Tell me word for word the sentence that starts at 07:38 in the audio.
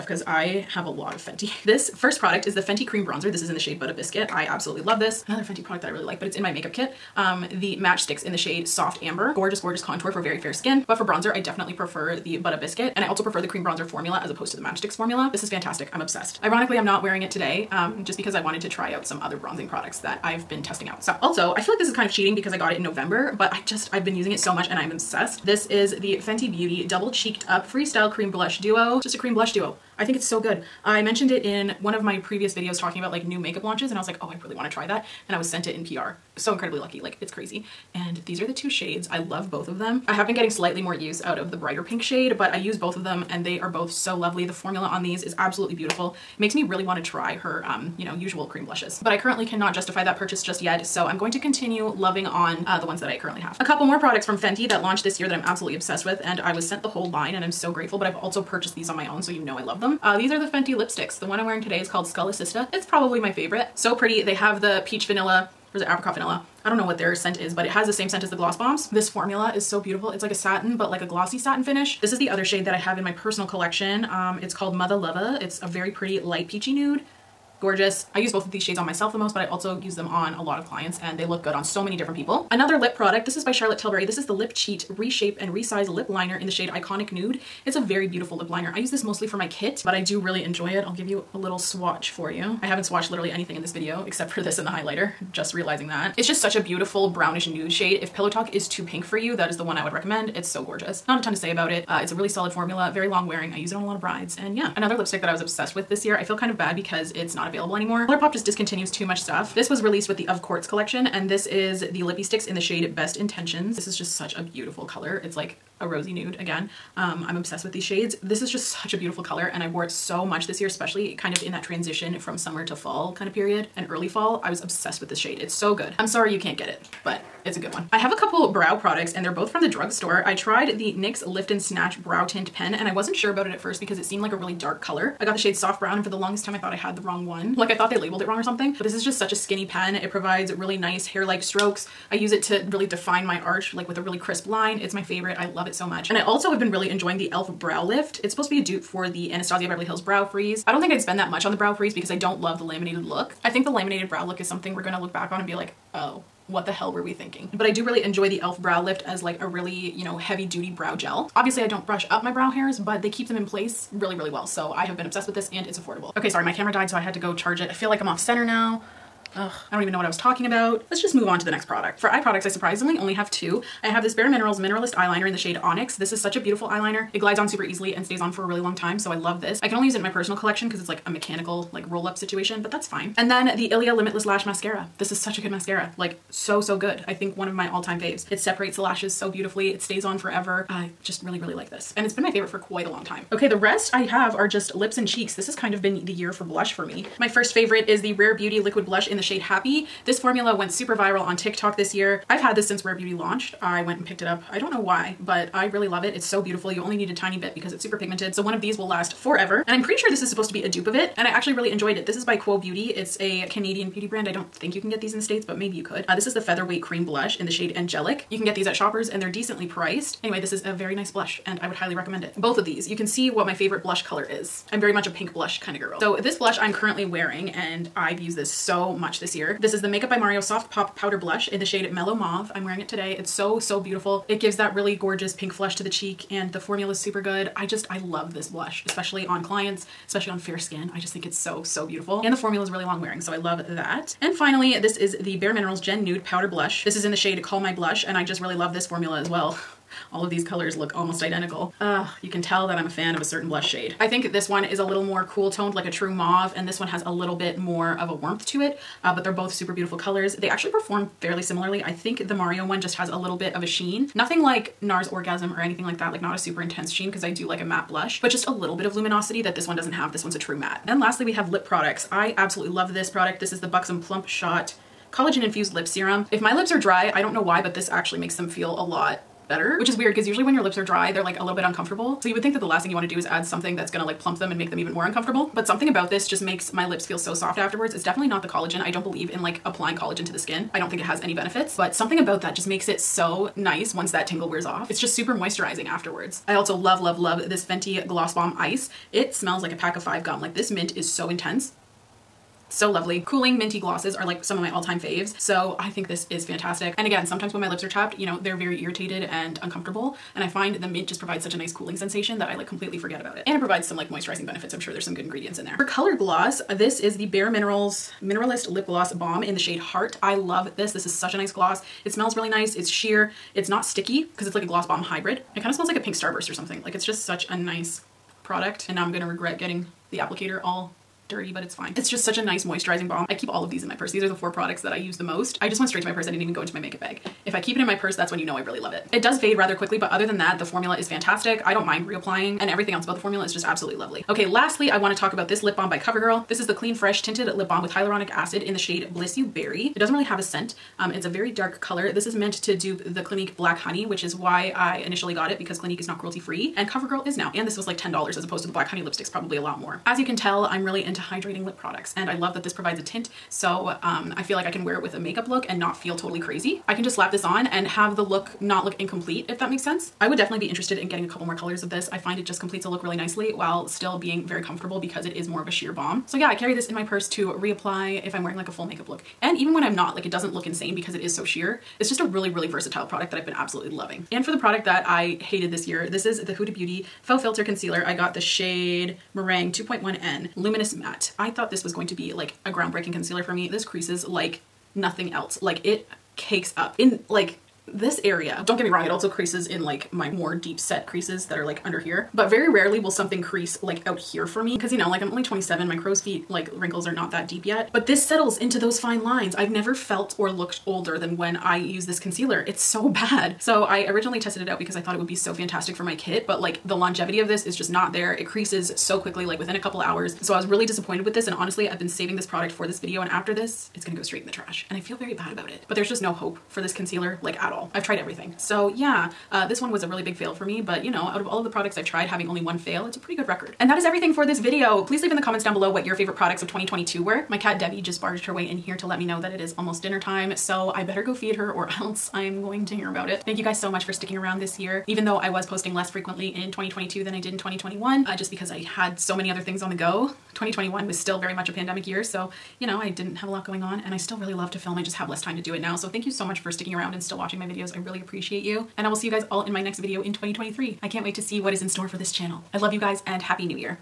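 And I will see you guys all in my next video in 2023.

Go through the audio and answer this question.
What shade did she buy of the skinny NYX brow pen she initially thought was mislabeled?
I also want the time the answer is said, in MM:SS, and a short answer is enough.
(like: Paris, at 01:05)
Soft Brown, at 02:15.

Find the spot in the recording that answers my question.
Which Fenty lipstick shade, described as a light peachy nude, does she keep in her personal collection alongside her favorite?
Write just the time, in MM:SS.
01:14.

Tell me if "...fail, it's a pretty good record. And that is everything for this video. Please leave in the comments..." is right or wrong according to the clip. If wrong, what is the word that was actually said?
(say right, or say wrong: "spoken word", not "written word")
right.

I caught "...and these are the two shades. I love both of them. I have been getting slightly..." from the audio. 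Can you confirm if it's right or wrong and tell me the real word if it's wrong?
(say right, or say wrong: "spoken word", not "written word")
right.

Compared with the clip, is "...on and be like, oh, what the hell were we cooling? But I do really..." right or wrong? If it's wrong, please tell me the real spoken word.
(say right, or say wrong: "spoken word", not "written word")
wrong: "thinking", not "cooling".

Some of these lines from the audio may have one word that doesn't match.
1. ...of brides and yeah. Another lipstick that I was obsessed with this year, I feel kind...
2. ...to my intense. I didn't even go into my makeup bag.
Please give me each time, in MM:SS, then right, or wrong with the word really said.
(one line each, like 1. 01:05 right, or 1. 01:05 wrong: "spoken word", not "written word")
1. 01:43 right
2. 05:36 wrong: "purse", not "intense".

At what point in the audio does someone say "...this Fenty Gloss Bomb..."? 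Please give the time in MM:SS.
04:57.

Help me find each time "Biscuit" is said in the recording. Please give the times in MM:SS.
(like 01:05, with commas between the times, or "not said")
00:03, 00:12.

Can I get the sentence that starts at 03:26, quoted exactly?
You only need a tiny bit because it's super pigmented.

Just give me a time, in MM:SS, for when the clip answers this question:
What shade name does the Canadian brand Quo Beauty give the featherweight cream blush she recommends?
03:37.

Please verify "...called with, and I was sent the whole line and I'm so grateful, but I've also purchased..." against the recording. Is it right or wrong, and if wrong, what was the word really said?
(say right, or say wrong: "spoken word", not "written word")
wrong: "obsessed", not "called".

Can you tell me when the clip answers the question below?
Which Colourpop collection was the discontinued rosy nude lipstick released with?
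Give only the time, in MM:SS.
01:50.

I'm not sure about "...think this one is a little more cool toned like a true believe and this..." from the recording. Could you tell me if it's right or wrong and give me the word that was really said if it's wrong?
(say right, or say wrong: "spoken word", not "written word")
wrong: "mauve", not "believe".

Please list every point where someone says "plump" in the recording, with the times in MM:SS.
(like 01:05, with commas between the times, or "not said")
04:33, 04:44.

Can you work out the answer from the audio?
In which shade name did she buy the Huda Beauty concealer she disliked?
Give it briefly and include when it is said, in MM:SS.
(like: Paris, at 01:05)
Meringue, at 06:29.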